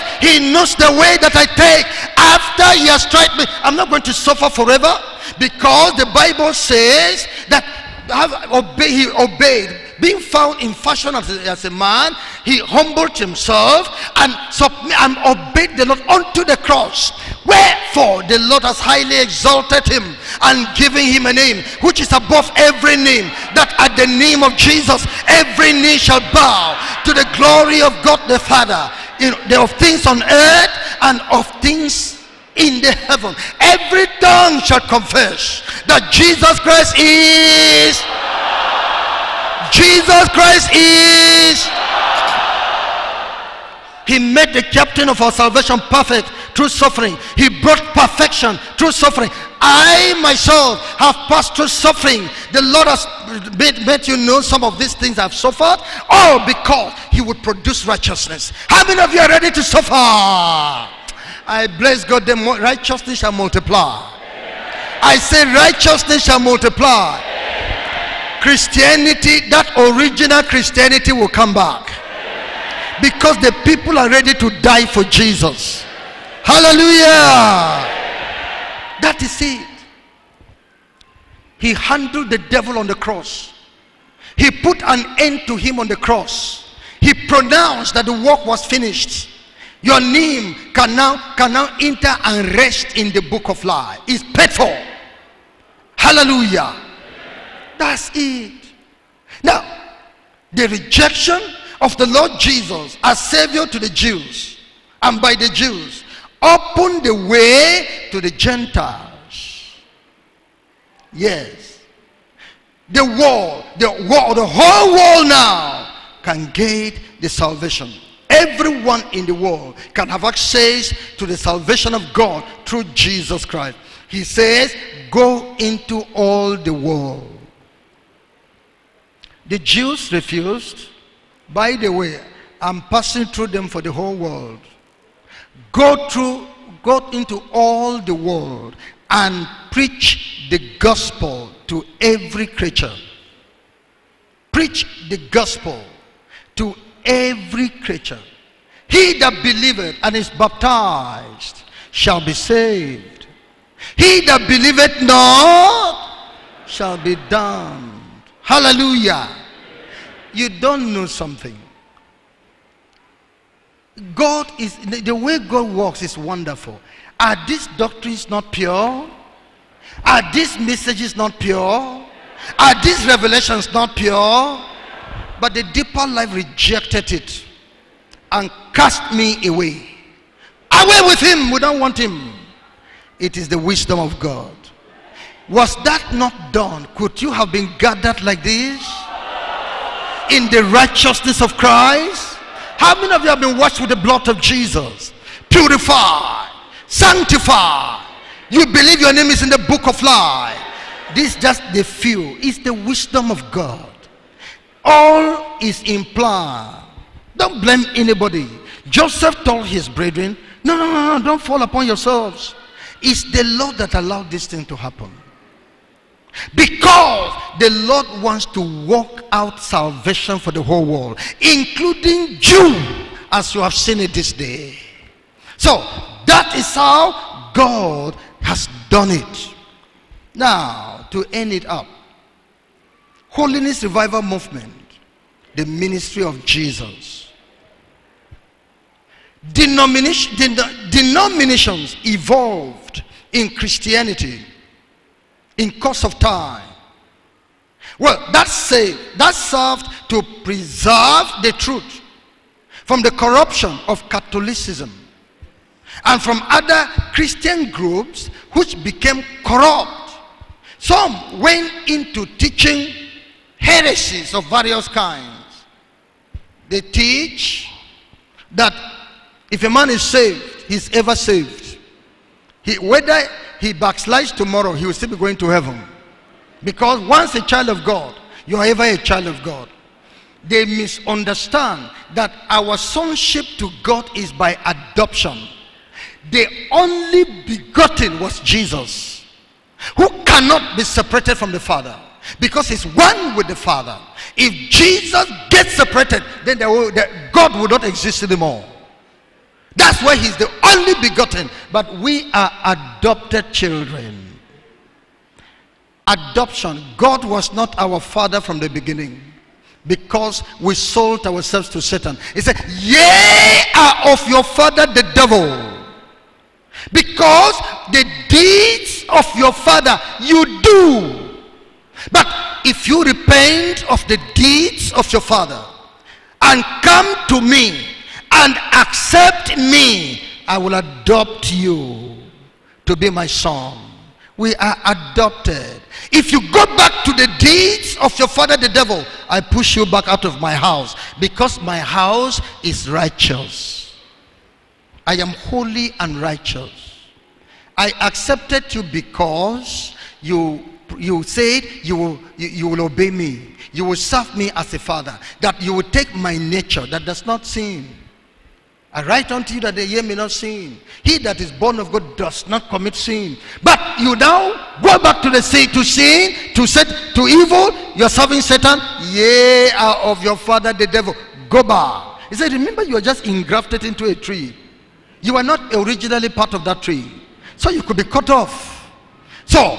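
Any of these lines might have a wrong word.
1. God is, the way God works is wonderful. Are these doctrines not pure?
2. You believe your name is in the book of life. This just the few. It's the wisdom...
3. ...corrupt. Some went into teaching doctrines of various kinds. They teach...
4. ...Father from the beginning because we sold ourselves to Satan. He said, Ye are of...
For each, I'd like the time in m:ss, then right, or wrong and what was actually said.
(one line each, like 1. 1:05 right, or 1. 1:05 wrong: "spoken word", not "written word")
1. 2:44 right
2. 3:18 right
3. 4:19 wrong: "heresies", not "doctrines"
4. 5:08 right.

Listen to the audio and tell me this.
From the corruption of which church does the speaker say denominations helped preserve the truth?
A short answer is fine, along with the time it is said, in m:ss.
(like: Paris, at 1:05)
Catholicism, at 4:14.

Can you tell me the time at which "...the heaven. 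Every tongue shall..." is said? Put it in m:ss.
0:32.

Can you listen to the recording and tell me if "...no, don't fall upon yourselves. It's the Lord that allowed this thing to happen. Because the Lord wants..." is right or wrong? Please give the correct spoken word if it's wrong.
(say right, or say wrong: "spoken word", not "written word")
right.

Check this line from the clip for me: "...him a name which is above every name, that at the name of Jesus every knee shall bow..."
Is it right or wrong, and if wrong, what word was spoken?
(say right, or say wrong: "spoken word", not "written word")
right.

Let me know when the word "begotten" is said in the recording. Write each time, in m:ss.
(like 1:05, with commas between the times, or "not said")
4:47, 5:01.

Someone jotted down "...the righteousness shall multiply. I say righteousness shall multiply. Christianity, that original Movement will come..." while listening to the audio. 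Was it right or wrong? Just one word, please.
wrong.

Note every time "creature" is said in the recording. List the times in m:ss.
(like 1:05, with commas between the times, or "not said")
2:22, 2:27.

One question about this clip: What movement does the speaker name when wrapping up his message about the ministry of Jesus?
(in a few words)
Holiness Revival Movement.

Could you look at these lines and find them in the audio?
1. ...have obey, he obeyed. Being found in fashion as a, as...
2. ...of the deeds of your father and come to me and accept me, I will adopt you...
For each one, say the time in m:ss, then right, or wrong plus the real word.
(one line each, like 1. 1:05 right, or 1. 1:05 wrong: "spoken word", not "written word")
1. 0:08 right
2. 5:23 right.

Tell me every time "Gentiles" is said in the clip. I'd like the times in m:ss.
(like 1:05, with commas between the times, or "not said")
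1:48.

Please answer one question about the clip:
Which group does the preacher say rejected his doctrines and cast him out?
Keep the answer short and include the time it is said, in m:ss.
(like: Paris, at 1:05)
The deeper life, at 2:55.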